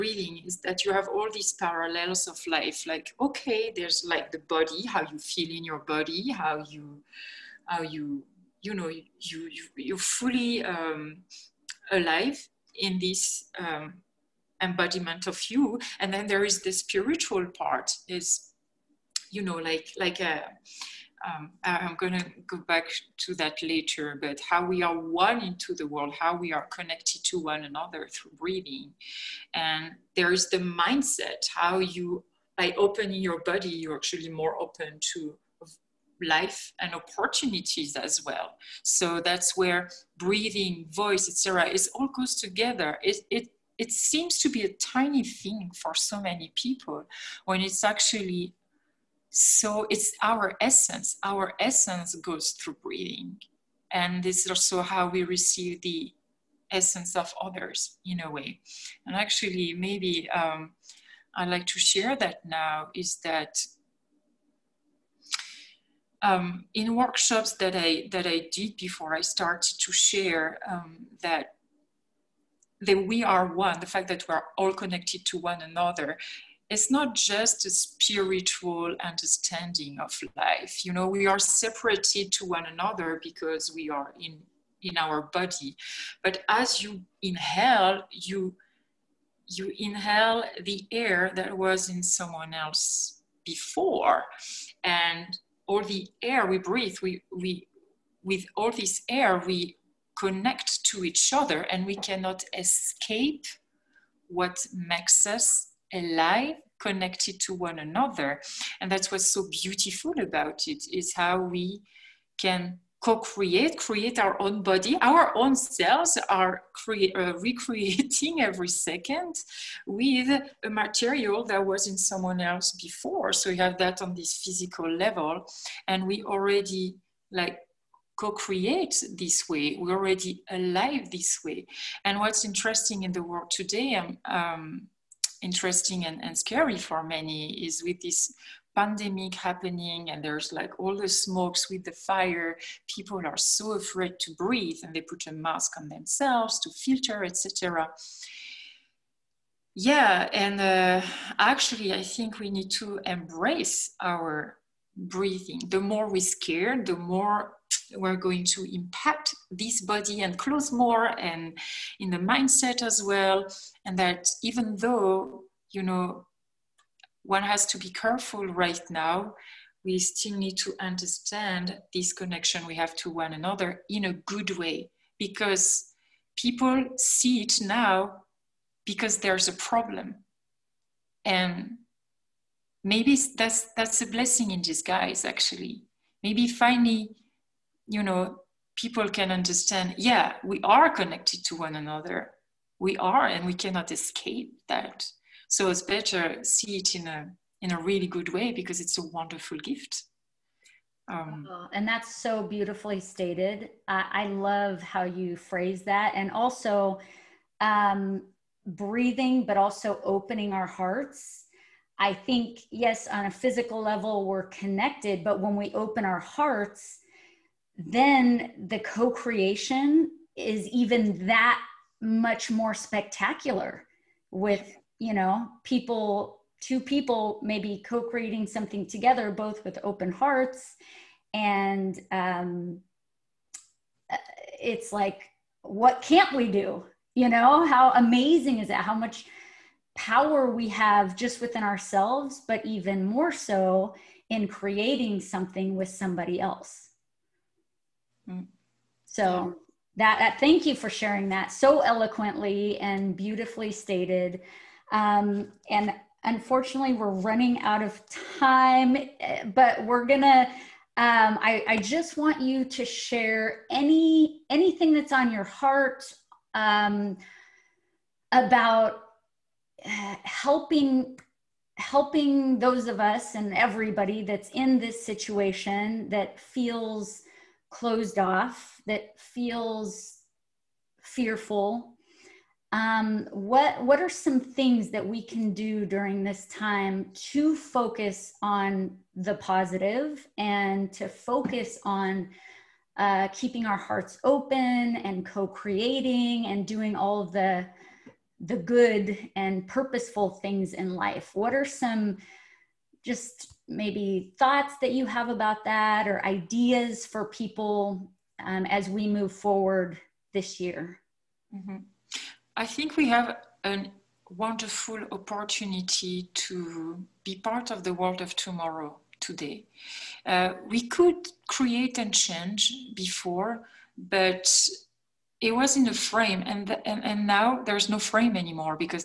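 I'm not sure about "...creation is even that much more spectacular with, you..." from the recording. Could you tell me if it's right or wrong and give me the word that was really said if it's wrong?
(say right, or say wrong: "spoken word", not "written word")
right.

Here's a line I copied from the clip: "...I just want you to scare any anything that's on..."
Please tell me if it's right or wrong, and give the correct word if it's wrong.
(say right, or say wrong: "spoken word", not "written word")
wrong: "share", not "scare".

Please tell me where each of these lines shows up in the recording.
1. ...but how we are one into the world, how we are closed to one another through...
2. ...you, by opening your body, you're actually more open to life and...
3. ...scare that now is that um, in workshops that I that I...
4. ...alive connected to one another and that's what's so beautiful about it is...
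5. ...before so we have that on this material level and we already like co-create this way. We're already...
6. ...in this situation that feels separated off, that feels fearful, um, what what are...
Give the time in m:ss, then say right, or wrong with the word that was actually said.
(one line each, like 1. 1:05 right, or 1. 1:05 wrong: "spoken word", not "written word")
1. 0:24 wrong: "connected", not "closed"
2. 0:31 right
3. 1:01 wrong: "share", not "scare"
4. 1:45 right
5. 2:02 wrong: "physical", not "material"
6. 4:34 wrong: "closed", not "separated".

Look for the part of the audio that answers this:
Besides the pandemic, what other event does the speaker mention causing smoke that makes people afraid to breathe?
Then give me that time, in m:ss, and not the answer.
2:21.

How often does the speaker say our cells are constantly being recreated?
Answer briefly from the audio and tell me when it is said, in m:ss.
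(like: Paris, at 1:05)
Every second, at 1:58.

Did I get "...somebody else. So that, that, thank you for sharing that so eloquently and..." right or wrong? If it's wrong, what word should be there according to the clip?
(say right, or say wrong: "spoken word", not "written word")
right.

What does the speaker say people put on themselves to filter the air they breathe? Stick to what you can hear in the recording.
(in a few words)
A mask.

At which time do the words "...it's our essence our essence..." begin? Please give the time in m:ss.
0:49.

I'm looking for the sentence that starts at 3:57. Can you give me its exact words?
You know, how amazing is that?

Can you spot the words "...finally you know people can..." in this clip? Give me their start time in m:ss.
3:06.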